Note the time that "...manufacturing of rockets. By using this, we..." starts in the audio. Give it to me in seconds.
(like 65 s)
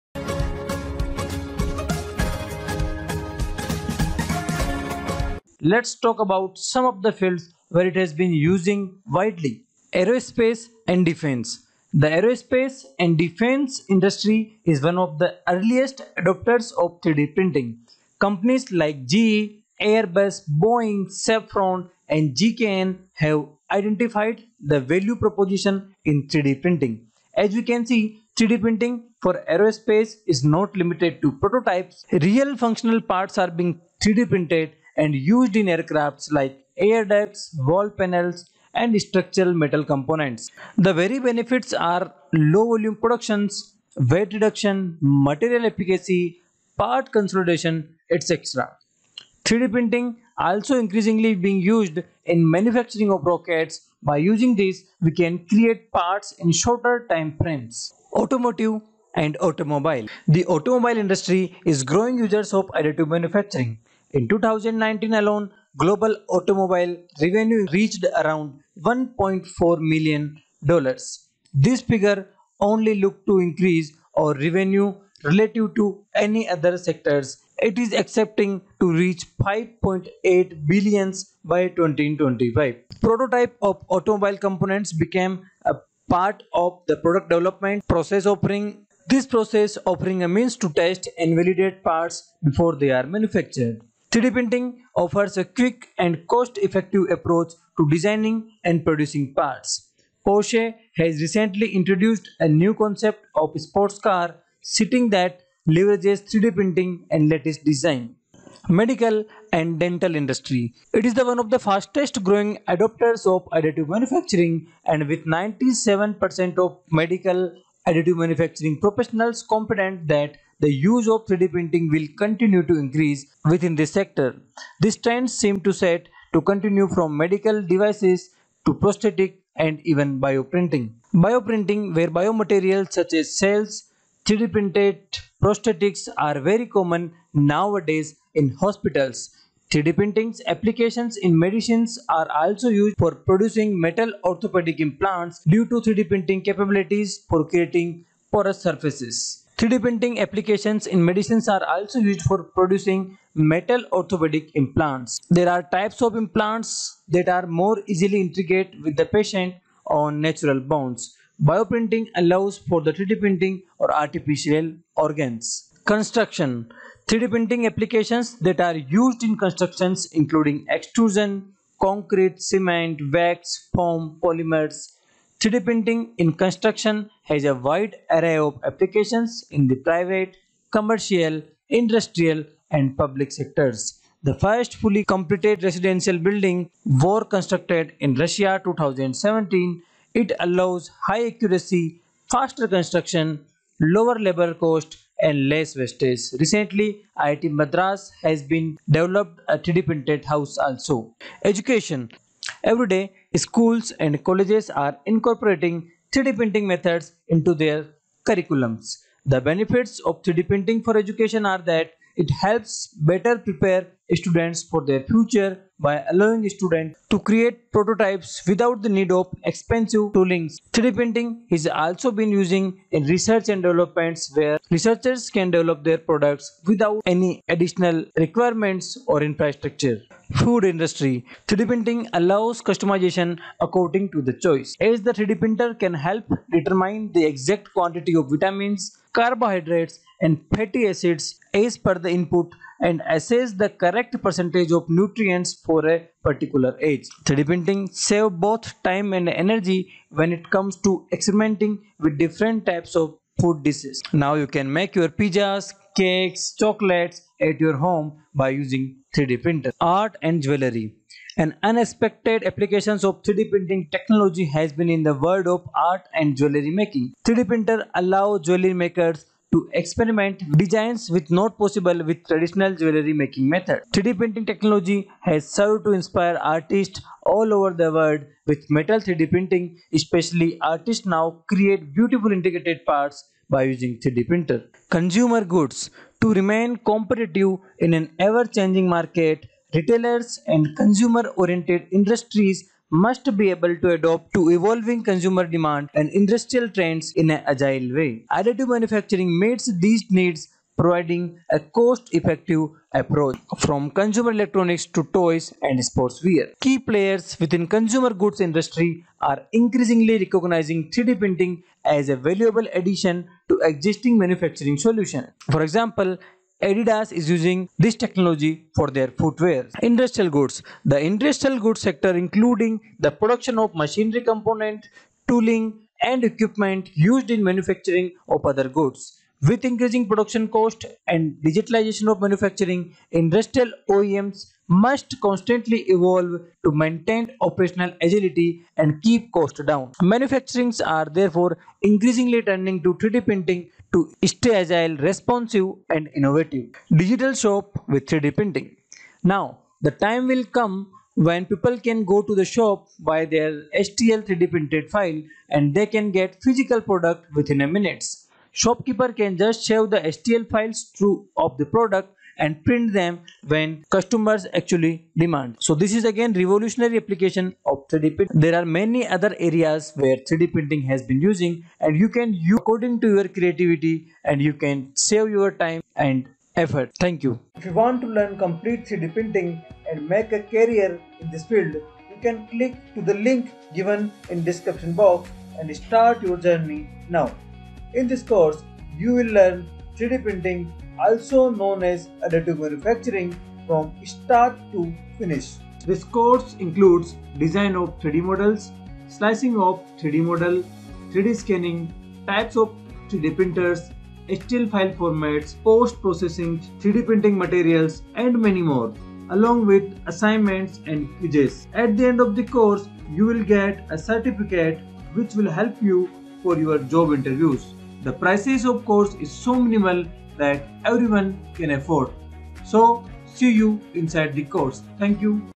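52 s.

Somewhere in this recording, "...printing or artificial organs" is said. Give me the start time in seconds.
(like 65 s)
163 s.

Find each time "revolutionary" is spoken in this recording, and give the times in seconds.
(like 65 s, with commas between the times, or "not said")
366 s.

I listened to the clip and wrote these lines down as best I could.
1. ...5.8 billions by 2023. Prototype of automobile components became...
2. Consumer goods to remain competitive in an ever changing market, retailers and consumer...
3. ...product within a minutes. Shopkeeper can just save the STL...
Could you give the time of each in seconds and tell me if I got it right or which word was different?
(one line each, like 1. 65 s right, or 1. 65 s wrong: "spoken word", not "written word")
1. 79 s wrong: "2025", not "2023"
2. 284 s right
3. 356 s right.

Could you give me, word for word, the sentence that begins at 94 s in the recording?
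3D printing offers a quick and cost-effective approach to designing and producing parts.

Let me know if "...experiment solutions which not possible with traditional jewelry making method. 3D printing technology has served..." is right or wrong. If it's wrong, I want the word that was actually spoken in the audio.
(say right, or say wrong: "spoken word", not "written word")
wrong: "designs", not "solutions".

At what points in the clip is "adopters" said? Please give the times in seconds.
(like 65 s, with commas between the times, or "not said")
16 s, 112 s.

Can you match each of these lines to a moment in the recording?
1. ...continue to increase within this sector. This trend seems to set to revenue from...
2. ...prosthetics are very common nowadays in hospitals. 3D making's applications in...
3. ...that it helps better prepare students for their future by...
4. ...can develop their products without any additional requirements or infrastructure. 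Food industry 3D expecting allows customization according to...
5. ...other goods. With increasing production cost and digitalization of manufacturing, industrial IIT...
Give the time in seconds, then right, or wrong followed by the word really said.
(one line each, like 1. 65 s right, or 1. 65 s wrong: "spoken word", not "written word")
1. 122 s wrong: "continue", not "revenue"
2. 135 s wrong: "printing", not "making"
3. 211 s right
4. 225 s wrong: "printing", not "expecting"
5. 328 s wrong: "OEMs", not "IIT".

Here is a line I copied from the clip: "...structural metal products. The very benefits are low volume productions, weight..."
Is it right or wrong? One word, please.
wrong.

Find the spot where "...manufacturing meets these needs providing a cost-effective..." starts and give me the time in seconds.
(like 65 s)
298 s.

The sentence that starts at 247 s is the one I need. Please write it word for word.
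3D printing save both time and energy when it comes to experimenting with different types of food dishes.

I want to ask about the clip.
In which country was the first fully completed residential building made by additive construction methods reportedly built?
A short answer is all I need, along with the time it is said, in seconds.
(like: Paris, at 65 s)
Russia, at 188 s.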